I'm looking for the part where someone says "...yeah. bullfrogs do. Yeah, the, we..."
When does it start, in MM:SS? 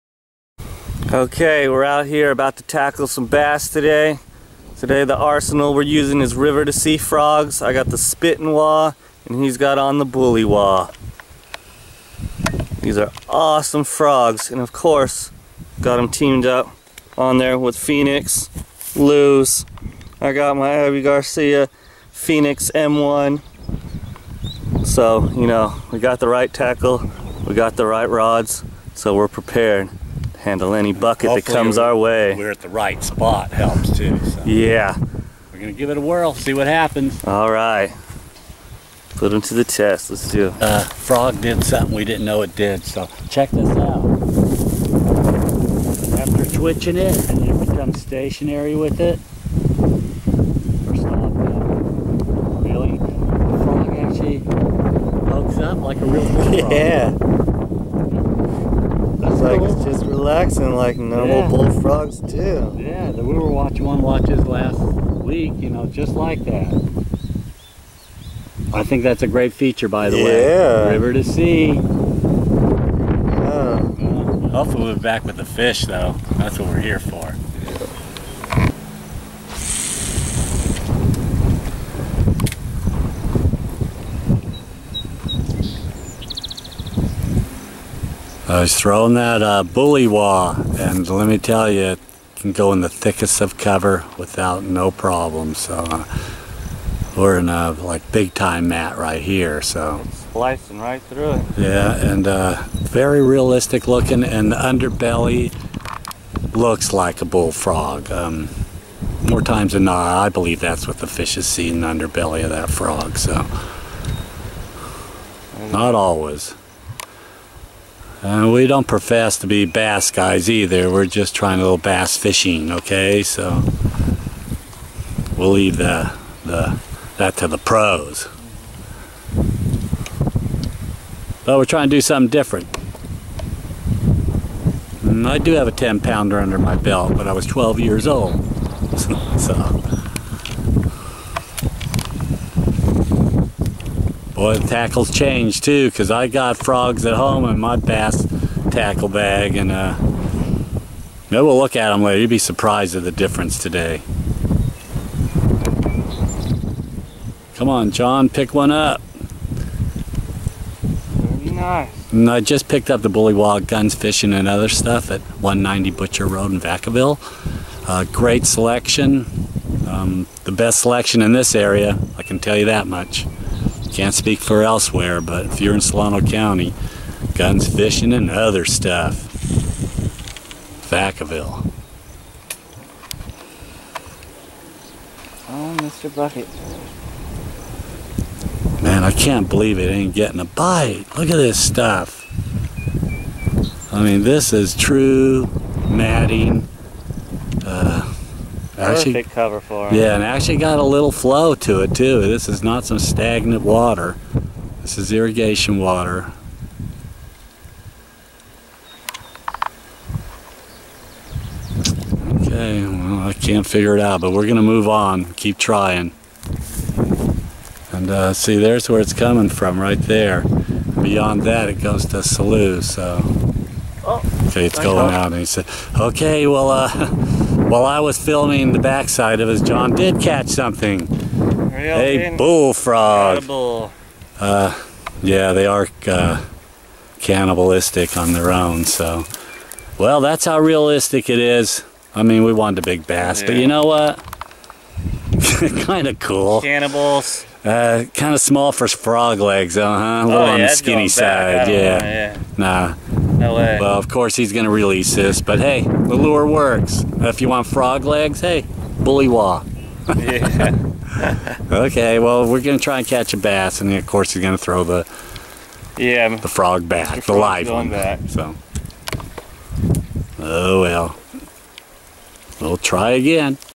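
01:01.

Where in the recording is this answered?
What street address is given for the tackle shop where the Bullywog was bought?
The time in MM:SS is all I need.
02:45.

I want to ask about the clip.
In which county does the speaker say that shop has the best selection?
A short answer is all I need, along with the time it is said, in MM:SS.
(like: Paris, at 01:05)
Solano County, at 02:55.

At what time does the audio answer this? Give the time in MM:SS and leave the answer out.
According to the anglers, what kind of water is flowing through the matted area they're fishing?
03:25.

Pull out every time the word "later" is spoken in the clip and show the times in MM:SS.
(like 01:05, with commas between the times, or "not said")
02:32.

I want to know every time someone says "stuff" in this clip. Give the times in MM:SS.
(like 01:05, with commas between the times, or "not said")
02:44, 02:58, 03:11.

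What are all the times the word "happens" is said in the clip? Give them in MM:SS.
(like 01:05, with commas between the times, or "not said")
00:36.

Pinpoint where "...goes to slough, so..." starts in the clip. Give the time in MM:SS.
03:41.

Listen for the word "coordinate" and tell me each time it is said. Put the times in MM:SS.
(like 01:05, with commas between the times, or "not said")
not said.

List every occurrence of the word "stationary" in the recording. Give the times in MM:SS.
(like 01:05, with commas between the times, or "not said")
00:48.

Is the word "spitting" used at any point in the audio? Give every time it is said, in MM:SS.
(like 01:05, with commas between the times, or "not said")
00:07.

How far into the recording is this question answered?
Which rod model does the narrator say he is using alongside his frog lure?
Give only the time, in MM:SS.
00:20.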